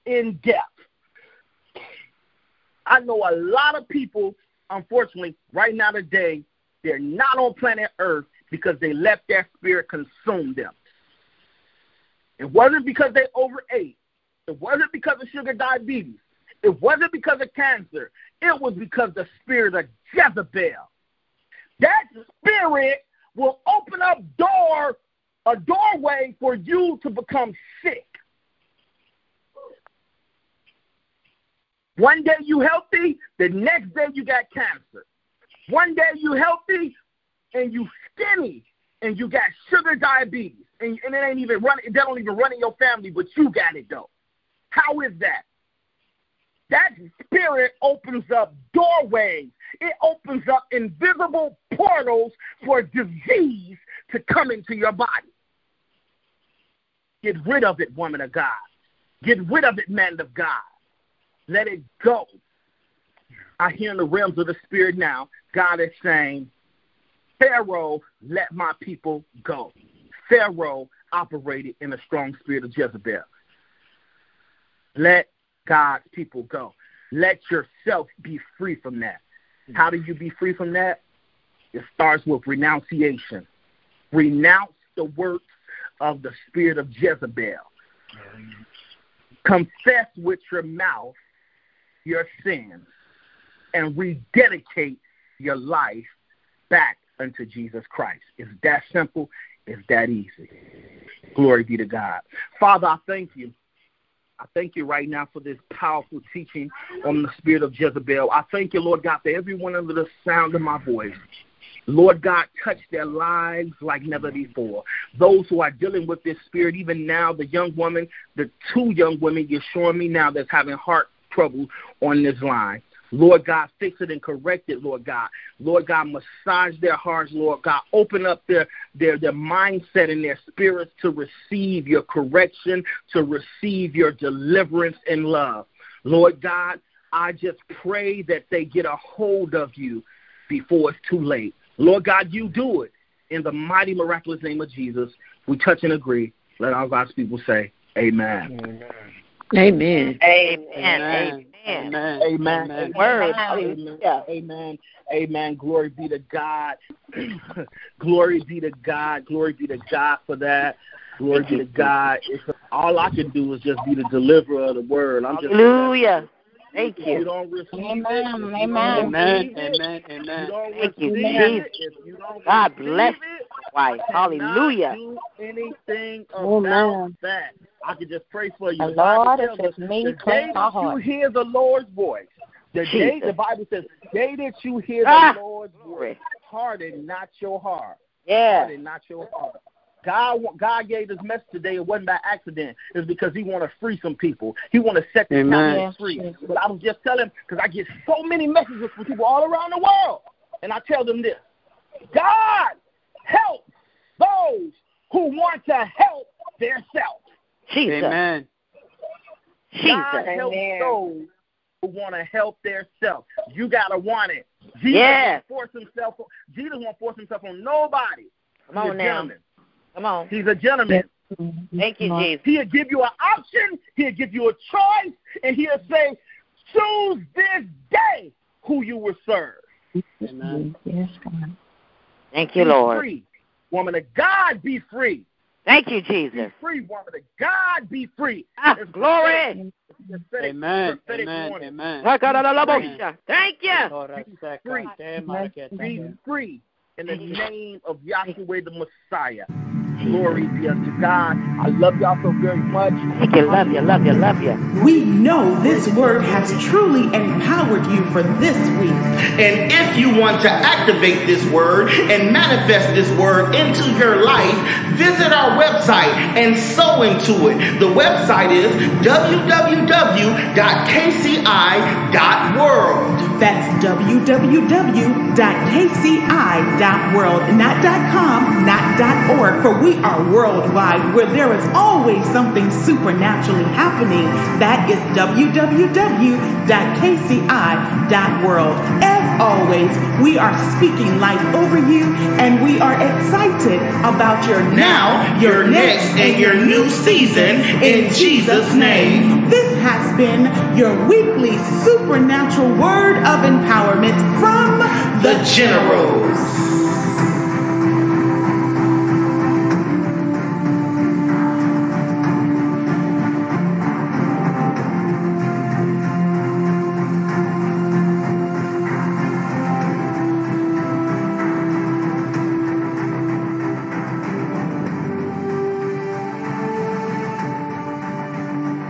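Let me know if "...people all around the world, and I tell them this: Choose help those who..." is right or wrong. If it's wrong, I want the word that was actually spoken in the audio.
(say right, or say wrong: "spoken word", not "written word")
wrong: "God", not "Choose".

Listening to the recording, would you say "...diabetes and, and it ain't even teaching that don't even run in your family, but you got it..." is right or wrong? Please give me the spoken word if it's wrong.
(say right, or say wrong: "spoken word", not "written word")
wrong: "running", not "teaching".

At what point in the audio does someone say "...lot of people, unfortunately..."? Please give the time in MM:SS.
00:03.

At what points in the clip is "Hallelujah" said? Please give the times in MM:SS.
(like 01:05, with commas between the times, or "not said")
02:45, 02:54.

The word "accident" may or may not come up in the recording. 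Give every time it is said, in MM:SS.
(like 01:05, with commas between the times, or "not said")
03:12.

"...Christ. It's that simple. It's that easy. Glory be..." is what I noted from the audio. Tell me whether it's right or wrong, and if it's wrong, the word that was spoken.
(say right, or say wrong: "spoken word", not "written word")
right.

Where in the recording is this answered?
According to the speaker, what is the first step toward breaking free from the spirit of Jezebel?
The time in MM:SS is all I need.
01:22.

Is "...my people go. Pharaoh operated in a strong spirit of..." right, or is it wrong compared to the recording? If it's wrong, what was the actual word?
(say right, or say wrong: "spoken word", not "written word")
right.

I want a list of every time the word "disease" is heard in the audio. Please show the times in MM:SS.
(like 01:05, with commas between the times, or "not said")
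00:52.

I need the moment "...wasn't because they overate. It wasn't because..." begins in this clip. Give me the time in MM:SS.
00:12.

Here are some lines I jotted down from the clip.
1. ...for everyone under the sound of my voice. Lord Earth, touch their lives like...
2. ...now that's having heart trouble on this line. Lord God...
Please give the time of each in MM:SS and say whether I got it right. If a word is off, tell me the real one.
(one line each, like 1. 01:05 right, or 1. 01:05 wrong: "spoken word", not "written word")
1. 01:49 wrong: "God", not "Earth"
2. 02:00 right.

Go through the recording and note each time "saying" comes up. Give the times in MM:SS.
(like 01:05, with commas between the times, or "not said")
01:06.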